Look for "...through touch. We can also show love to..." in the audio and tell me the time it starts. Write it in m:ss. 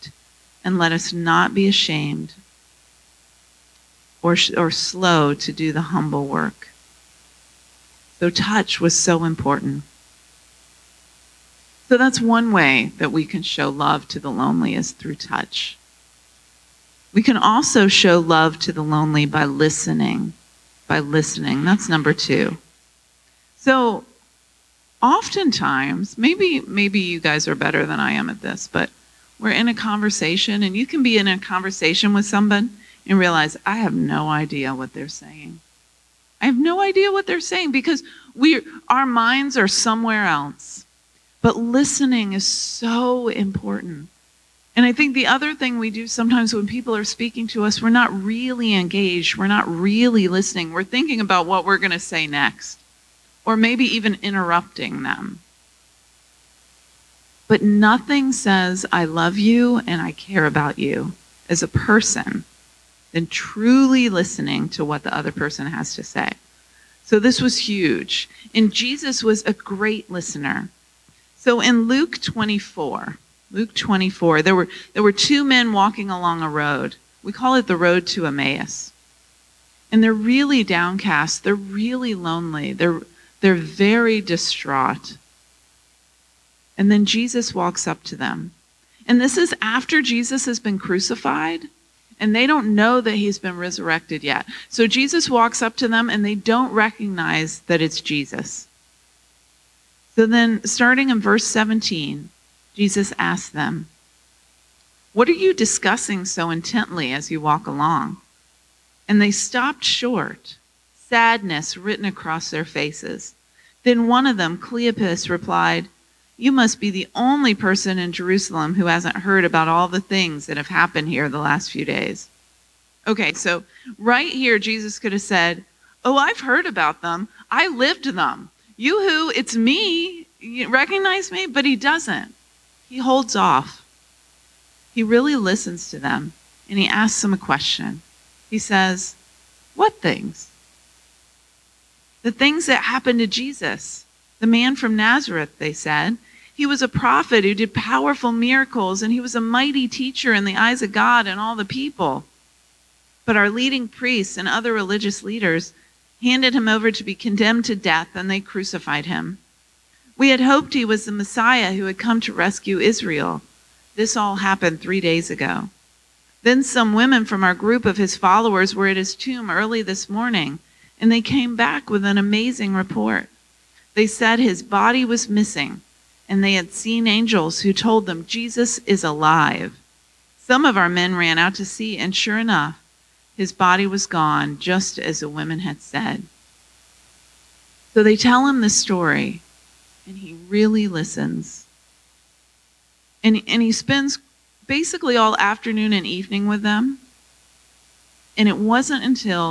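0:14.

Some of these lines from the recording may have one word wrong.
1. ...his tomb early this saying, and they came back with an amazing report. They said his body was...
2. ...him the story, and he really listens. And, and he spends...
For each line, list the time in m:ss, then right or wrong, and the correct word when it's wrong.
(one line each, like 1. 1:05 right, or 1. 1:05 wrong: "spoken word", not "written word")
1. 2:48 wrong: "morning", not "saying"
2. 3:08 right.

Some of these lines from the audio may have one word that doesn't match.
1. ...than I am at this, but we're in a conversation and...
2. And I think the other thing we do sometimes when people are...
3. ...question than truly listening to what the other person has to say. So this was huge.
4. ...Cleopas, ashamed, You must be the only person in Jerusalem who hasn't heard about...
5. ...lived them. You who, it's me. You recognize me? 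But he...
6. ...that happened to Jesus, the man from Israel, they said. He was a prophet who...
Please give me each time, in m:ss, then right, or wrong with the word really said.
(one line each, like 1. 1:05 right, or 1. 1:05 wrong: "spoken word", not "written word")
1. 0:27 right
2. 0:44 right
3. 1:01 wrong: "person", not "question"
4. 1:54 wrong: "replied", not "ashamed"
5. 2:07 right
6. 2:22 wrong: "Nazareth", not "Israel".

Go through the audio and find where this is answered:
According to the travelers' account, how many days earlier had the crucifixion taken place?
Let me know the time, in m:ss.
2:44.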